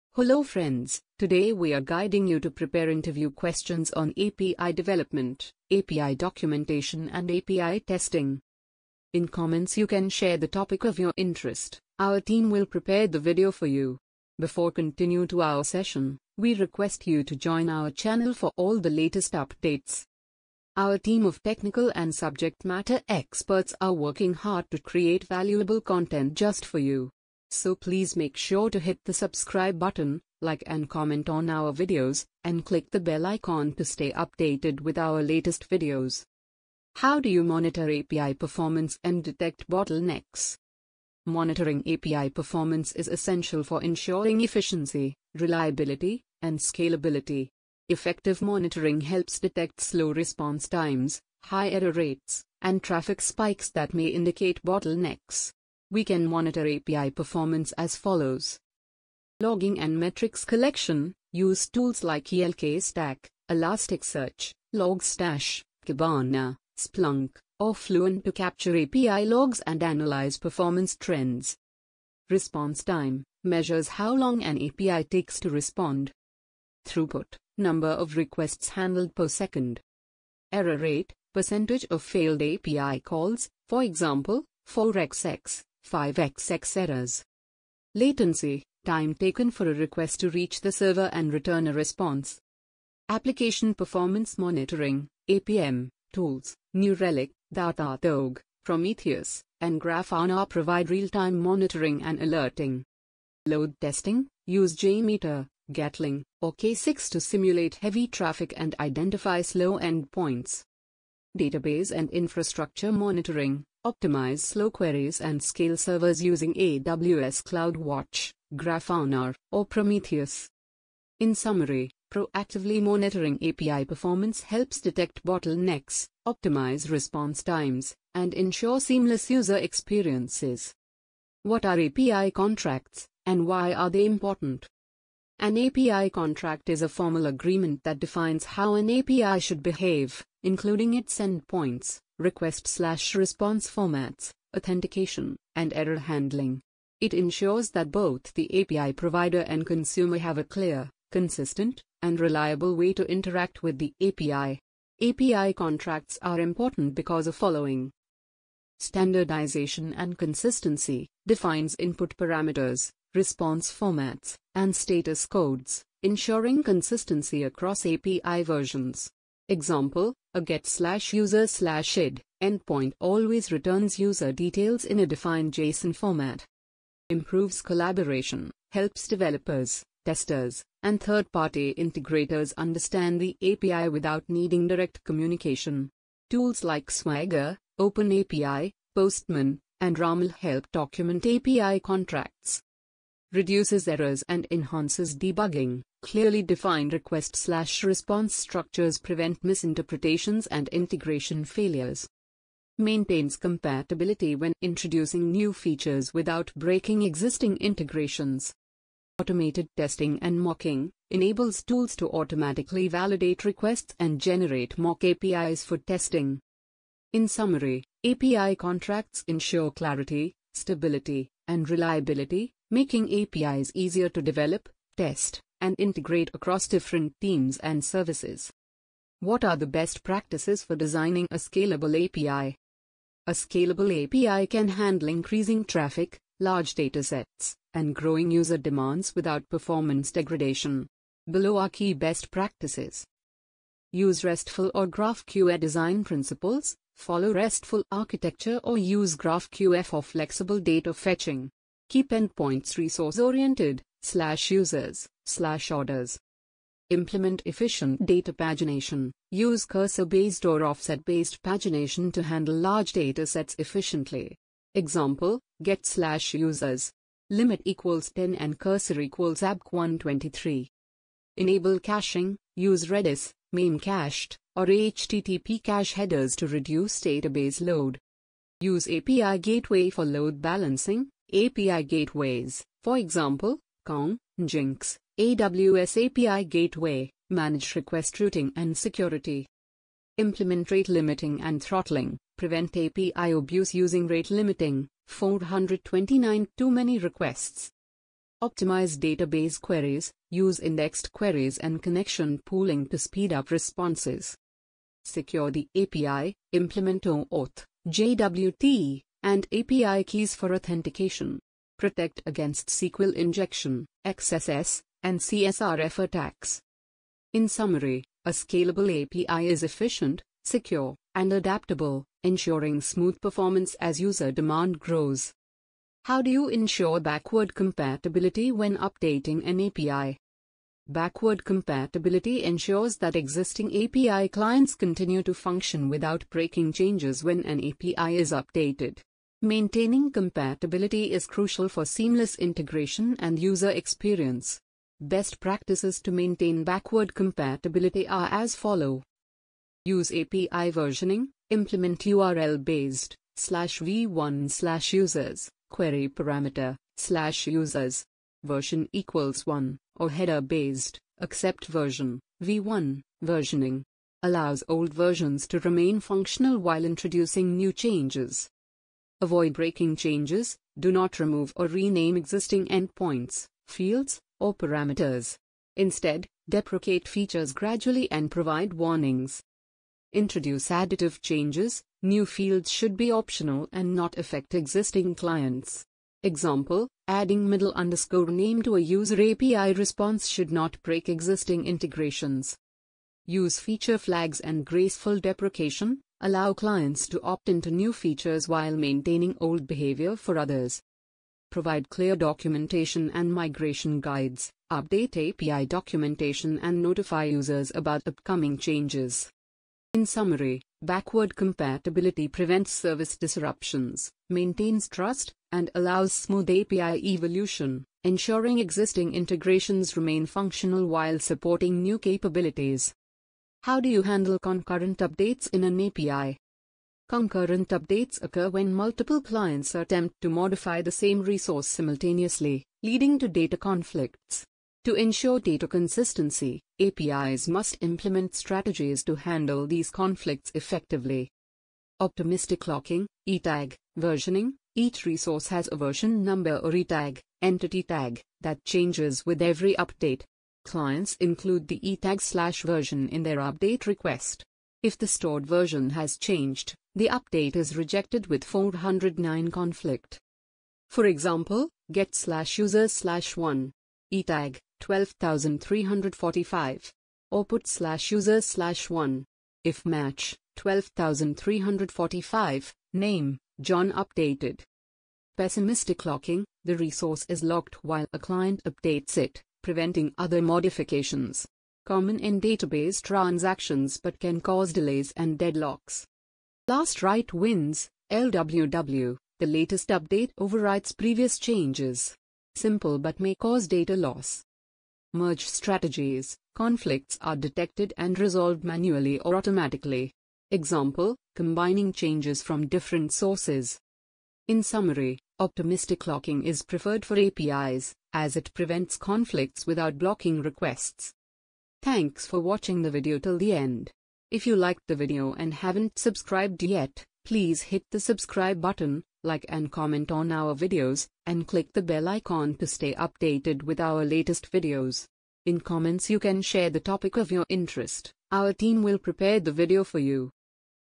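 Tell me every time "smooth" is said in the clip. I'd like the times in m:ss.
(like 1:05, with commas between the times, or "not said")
5:22, 6:56.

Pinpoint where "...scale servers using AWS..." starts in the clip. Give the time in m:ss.
1:55.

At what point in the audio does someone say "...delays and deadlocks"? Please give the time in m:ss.
8:04.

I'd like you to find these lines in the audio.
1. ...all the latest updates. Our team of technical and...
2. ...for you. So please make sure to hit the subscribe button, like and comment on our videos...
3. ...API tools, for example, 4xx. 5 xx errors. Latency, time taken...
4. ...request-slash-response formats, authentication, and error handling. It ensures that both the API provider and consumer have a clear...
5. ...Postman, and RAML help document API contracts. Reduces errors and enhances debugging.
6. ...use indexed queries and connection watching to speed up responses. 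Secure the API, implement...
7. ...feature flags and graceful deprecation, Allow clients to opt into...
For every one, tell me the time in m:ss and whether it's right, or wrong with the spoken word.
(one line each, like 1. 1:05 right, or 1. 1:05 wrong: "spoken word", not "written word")
1. 0:18 right
2. 0:26 right
3. 1:22 wrong: "calls", not "tools"
4. 2:22 right
5. 3:08 right
6. 5:00 wrong: "pooling", not "watching"
7. 6:33 right.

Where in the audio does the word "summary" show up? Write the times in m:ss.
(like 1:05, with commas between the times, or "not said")
2:01, 3:37, 5:17, 6:50, 8:24.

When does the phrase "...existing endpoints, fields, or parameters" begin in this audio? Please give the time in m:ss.
6:12.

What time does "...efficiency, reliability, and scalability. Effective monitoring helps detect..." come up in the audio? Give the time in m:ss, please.
0:44.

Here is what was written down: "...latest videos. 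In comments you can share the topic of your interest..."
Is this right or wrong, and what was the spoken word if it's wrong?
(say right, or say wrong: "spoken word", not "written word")
right.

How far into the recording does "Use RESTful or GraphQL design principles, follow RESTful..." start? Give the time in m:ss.
4:03.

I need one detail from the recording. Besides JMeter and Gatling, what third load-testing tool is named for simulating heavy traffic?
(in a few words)
K6.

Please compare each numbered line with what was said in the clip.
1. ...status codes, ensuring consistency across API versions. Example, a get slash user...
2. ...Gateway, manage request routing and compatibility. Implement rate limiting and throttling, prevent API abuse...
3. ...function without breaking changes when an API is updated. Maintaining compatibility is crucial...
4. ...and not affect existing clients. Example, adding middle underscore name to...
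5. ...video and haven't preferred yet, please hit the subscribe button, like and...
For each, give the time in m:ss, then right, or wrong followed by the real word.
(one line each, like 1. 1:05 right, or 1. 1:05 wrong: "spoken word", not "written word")
1. 2:44 right
2. 4:46 wrong: "security", not "compatibility"
3. 5:35 right
4. 6:23 right
5. 8:34 wrong: "subscribed", not "preferred".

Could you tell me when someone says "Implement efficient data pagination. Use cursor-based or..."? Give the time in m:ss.
4:16.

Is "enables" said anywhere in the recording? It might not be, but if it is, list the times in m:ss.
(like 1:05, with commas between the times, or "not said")
3:31, 4:31.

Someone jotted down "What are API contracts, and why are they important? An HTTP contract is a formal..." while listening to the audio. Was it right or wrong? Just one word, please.
wrong.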